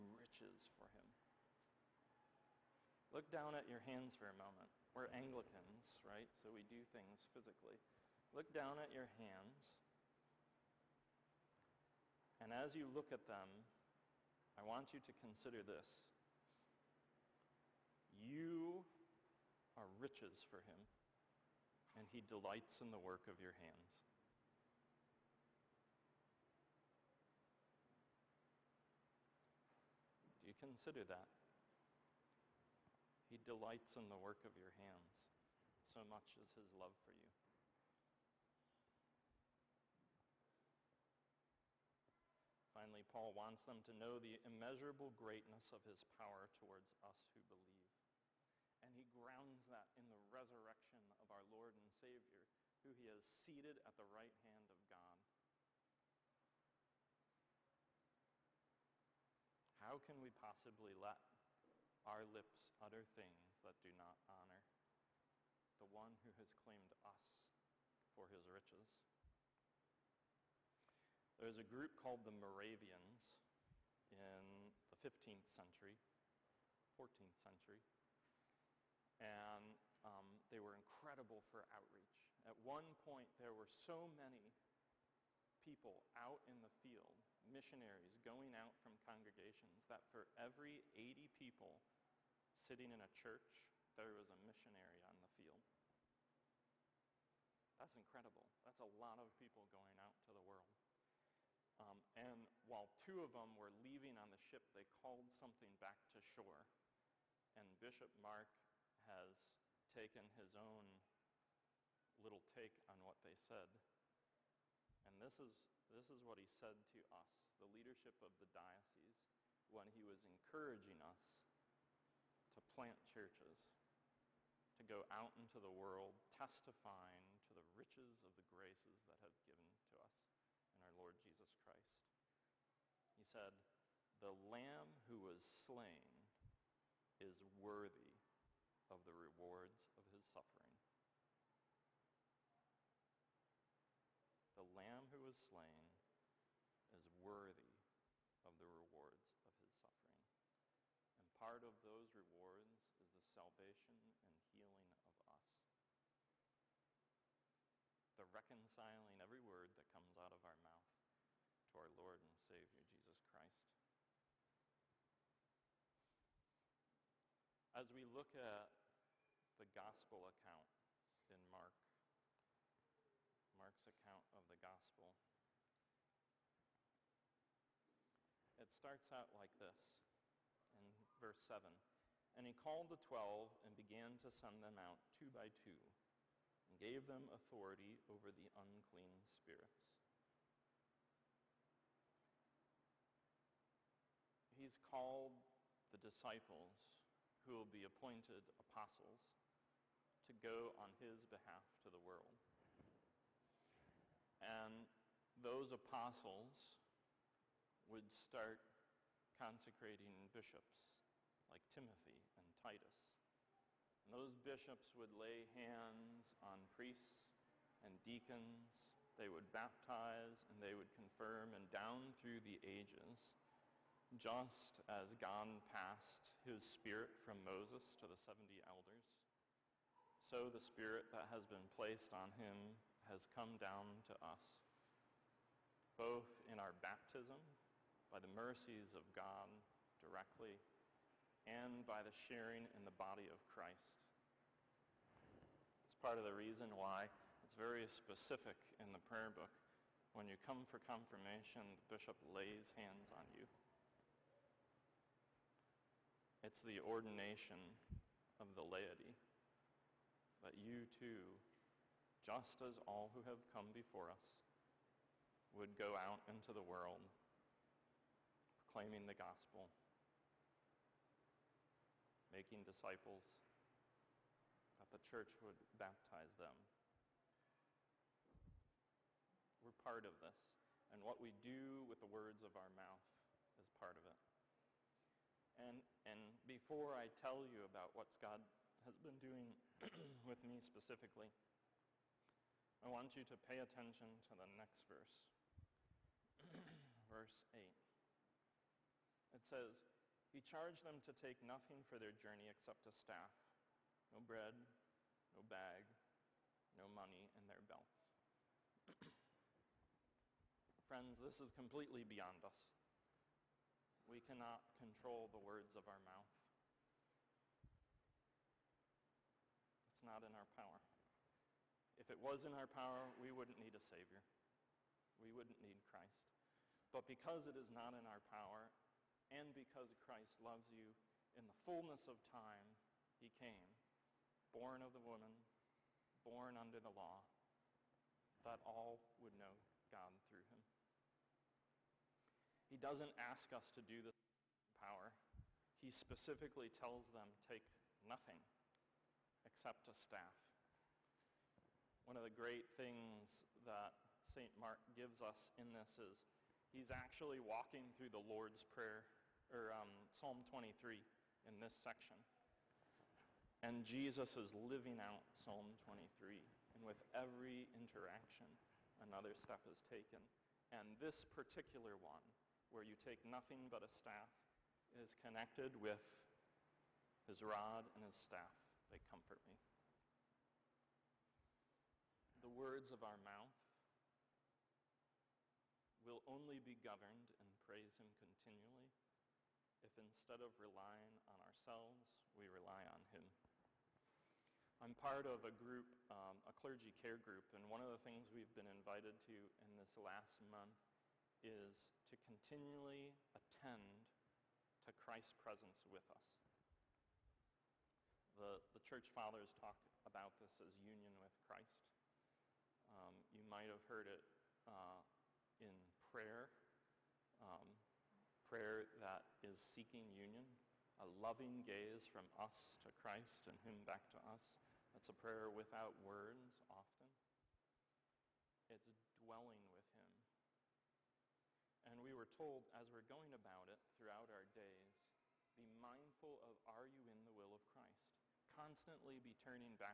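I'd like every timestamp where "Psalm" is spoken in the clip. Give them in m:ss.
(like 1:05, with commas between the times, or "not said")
6:00, 6:05.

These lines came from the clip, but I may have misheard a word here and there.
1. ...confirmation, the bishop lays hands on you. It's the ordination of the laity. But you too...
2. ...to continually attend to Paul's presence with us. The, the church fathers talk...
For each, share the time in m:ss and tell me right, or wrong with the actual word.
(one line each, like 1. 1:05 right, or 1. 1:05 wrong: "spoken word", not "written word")
1. 4:10 right
2. 6:42 wrong: "Christ", not "Paul".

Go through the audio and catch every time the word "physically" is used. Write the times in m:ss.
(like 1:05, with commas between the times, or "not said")
0:07.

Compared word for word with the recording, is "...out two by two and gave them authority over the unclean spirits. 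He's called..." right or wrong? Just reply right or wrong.
right.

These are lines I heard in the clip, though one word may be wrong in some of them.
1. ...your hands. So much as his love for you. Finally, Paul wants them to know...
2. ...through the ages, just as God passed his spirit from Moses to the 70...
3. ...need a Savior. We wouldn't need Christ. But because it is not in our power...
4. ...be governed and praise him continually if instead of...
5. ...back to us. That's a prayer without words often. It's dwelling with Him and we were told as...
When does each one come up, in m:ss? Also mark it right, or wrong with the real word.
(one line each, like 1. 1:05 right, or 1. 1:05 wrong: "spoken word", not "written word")
1. 0:34 right
2. 3:42 right
3. 5:23 right
4. 6:26 right
5. 7:03 right.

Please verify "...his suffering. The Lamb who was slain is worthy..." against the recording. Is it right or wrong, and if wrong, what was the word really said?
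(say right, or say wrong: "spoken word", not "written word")
right.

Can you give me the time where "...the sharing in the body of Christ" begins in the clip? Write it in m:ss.
4:02.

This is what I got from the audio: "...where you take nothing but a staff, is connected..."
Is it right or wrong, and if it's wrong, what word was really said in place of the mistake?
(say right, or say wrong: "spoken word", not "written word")
right.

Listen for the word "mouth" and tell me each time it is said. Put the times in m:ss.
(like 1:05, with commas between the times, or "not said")
2:40, 4:42, 5:15, 6:23.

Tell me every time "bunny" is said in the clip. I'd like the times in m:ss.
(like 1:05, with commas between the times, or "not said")
not said.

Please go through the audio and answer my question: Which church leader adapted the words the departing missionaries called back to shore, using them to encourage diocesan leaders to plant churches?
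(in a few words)
Bishop Mark.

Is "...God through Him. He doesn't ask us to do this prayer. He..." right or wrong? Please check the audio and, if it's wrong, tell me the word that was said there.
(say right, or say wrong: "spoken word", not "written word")
wrong: "power", not "prayer".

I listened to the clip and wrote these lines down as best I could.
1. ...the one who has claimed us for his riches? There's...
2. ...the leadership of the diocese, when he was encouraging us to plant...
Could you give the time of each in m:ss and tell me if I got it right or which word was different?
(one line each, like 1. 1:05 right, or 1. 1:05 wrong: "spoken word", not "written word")
1. 1:05 right
2. 1:57 right.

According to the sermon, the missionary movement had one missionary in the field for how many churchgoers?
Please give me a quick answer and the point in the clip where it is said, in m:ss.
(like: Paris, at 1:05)
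80, at 1:30.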